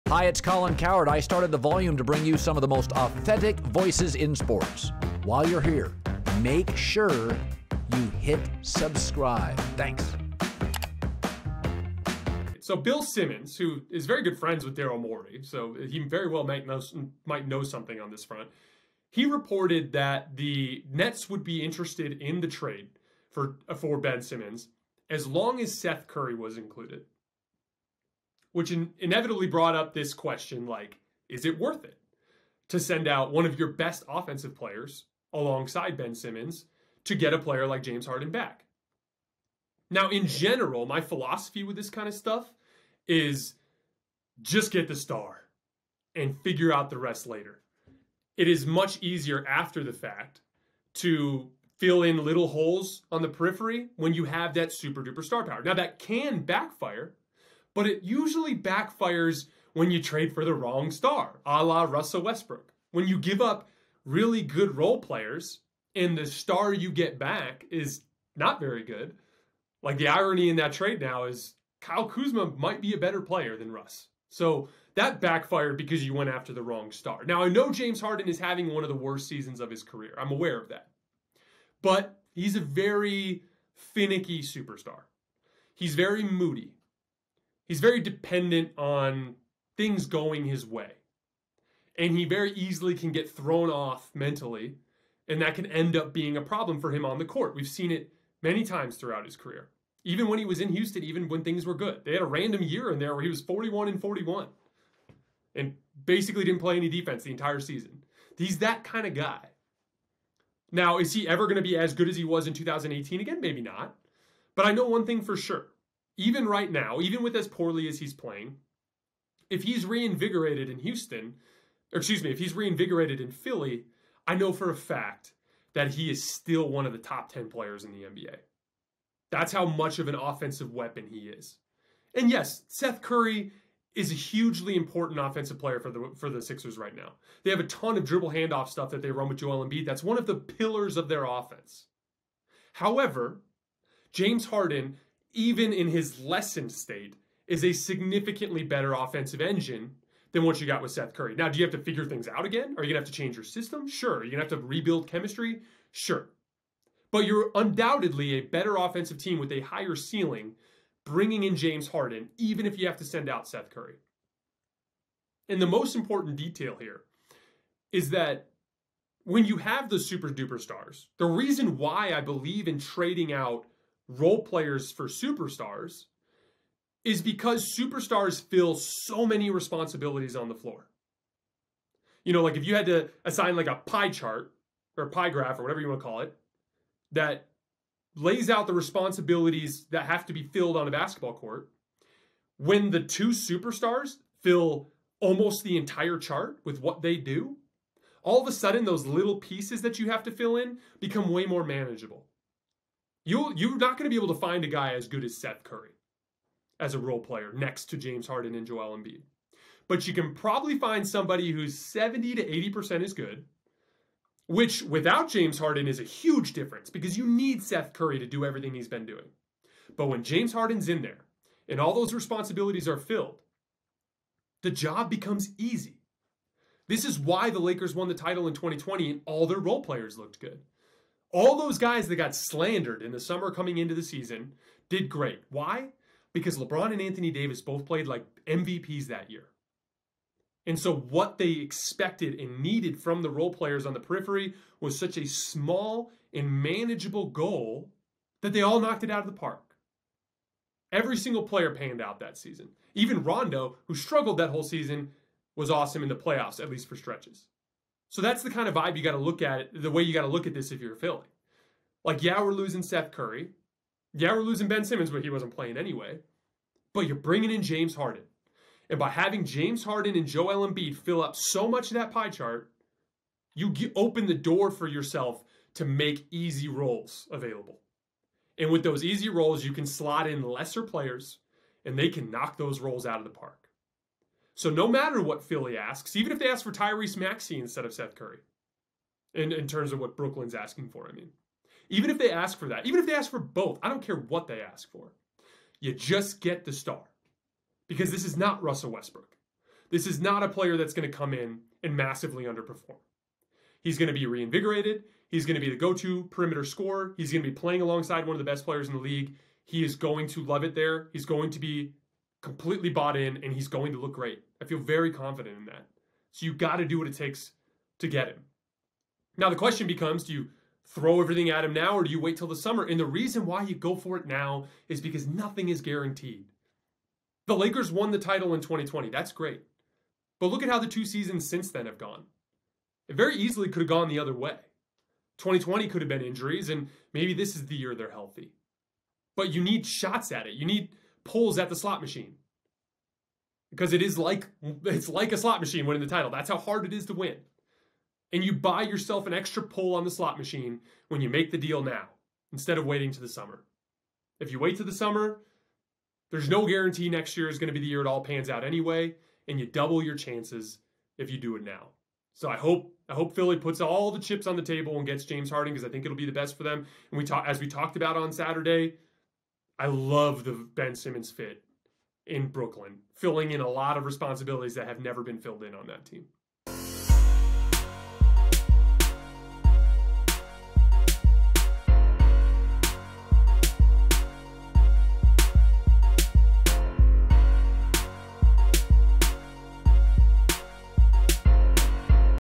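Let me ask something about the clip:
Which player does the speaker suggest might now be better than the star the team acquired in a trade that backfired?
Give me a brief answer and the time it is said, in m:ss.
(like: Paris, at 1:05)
Kyle Kuzma, at 1:11.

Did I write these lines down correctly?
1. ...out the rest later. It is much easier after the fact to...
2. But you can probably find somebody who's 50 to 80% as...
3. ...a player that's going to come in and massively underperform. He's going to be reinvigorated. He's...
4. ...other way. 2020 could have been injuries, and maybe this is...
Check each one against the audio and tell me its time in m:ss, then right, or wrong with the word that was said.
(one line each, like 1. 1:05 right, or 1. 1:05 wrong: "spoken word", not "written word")
1. 0:46 right
2. 3:29 wrong: "70", not "50"
3. 5:00 right
4. 5:34 right.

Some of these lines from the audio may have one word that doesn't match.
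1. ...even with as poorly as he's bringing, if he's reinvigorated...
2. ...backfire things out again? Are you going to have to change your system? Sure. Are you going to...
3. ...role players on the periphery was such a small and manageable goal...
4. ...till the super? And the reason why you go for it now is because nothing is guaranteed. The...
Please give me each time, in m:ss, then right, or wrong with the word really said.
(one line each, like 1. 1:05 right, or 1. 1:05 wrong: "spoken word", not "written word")
1. 1:57 wrong: "playing", not "bringing"
2. 2:31 wrong: "figure", not "backfire"
3. 4:03 right
4. 5:22 wrong: "summer", not "super".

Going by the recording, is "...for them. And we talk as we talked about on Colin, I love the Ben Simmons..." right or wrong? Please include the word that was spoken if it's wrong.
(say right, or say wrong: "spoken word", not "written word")
wrong: "Saturday", not "Colin".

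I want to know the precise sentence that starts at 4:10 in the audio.
Every single player panned out that season.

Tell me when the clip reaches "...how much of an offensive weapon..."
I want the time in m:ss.
2:09.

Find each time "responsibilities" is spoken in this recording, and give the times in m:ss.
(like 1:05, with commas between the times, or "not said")
2:59, 3:08, 3:42, 6:14.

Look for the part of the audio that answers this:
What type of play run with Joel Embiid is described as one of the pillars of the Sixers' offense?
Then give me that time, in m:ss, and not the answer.
2:18.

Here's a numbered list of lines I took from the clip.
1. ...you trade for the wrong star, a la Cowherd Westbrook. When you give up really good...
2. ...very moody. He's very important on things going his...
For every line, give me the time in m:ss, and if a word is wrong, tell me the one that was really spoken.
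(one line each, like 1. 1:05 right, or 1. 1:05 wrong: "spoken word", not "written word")
1. 0:59 wrong: "Russell", not "Cowherd"
2. 1:25 wrong: "dependent", not "important".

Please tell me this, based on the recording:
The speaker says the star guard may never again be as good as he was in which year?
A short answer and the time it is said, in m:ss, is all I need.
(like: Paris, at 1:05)
2018, at 1:52.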